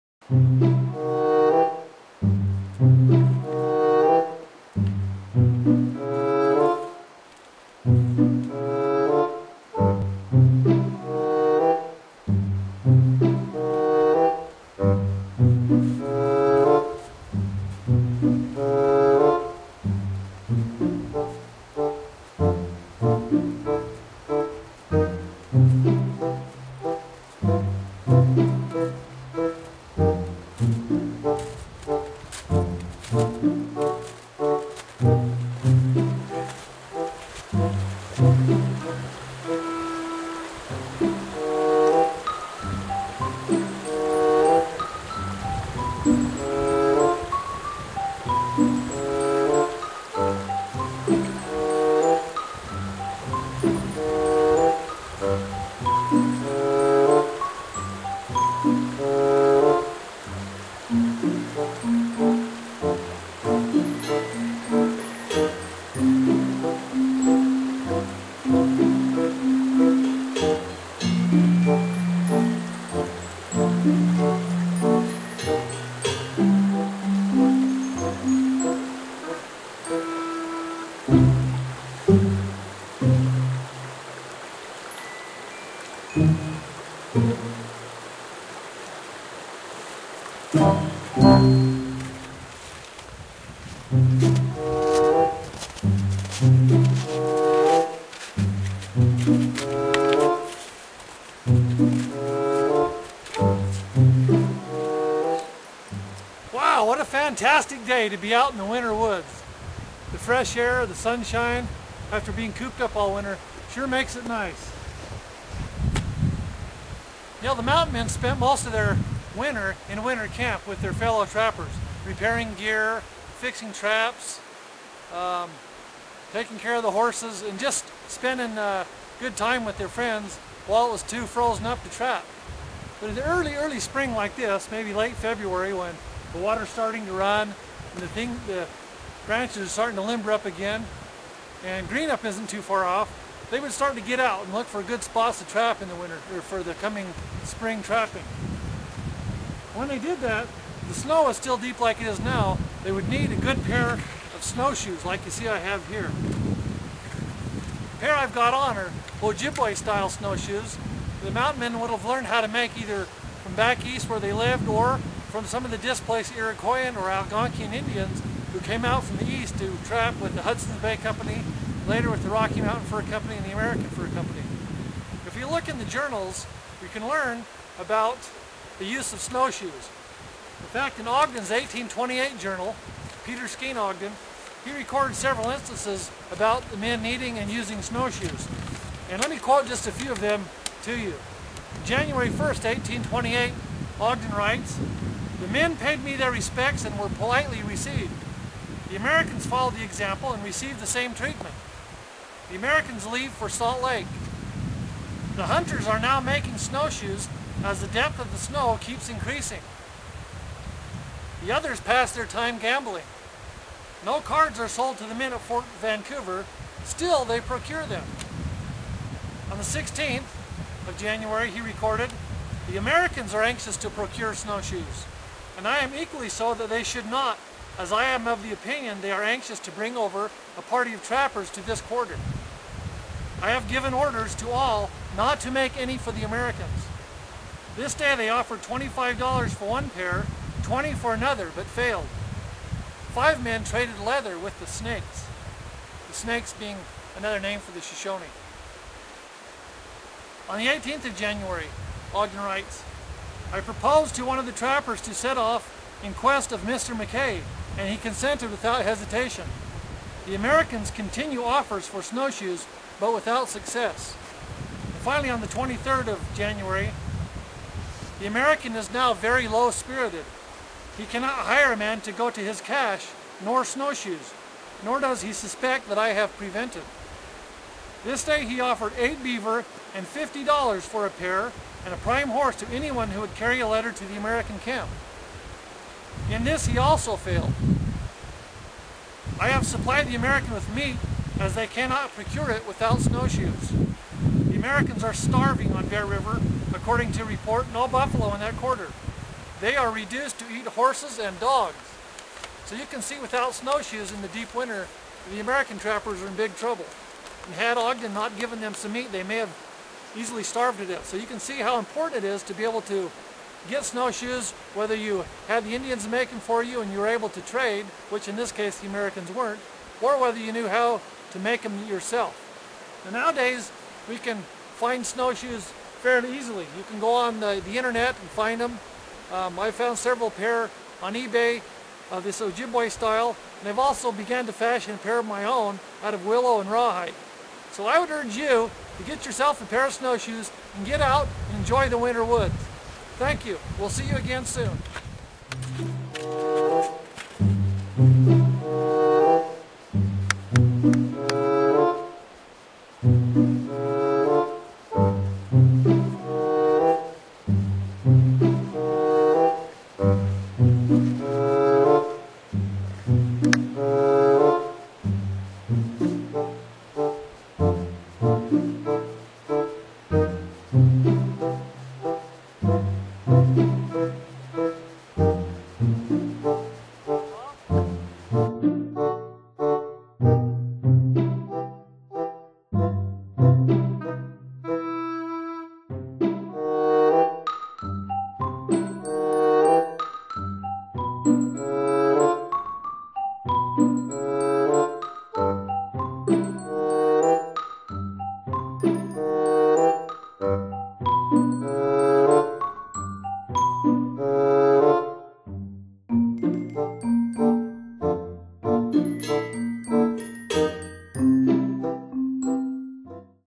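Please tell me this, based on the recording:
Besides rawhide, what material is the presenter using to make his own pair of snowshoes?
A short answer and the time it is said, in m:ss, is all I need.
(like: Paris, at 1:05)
willow, at 5:36.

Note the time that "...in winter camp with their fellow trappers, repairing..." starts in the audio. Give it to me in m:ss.
1:59.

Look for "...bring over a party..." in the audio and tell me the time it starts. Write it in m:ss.
3:49.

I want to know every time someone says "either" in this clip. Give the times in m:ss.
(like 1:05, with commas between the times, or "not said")
2:42.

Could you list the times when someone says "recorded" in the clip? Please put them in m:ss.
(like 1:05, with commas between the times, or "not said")
3:04, 3:41.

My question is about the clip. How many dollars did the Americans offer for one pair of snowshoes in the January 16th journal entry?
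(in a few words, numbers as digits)
$25.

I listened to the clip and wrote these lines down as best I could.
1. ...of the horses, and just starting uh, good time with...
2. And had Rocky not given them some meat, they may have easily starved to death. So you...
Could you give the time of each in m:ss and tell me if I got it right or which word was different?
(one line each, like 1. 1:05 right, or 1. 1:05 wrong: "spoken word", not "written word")
1. 2:06 wrong: "spending", not "starting"
2. 5:07 wrong: "Ogden", not "Rocky".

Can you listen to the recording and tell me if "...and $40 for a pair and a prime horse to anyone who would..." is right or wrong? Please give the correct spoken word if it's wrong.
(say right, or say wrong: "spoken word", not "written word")
wrong: "50", not "40".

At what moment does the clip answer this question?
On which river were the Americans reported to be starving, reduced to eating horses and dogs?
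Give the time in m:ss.
4:55.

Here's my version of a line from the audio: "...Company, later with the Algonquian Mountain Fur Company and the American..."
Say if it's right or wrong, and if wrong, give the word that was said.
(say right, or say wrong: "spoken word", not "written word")
wrong: "Rocky", not "Algonquian".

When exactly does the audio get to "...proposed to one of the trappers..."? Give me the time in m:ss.
4:13.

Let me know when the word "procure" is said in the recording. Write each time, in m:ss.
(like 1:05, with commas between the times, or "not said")
3:37, 3:43, 4:52.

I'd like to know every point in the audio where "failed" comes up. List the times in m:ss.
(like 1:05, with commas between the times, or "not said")
4:01, 4:47.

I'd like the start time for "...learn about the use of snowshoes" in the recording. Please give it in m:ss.
2:57.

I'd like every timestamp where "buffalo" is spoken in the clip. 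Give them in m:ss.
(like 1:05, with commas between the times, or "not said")
4:57.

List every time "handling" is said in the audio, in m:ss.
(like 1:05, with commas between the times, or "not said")
not said.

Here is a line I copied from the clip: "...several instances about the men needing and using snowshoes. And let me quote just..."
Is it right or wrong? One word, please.
right.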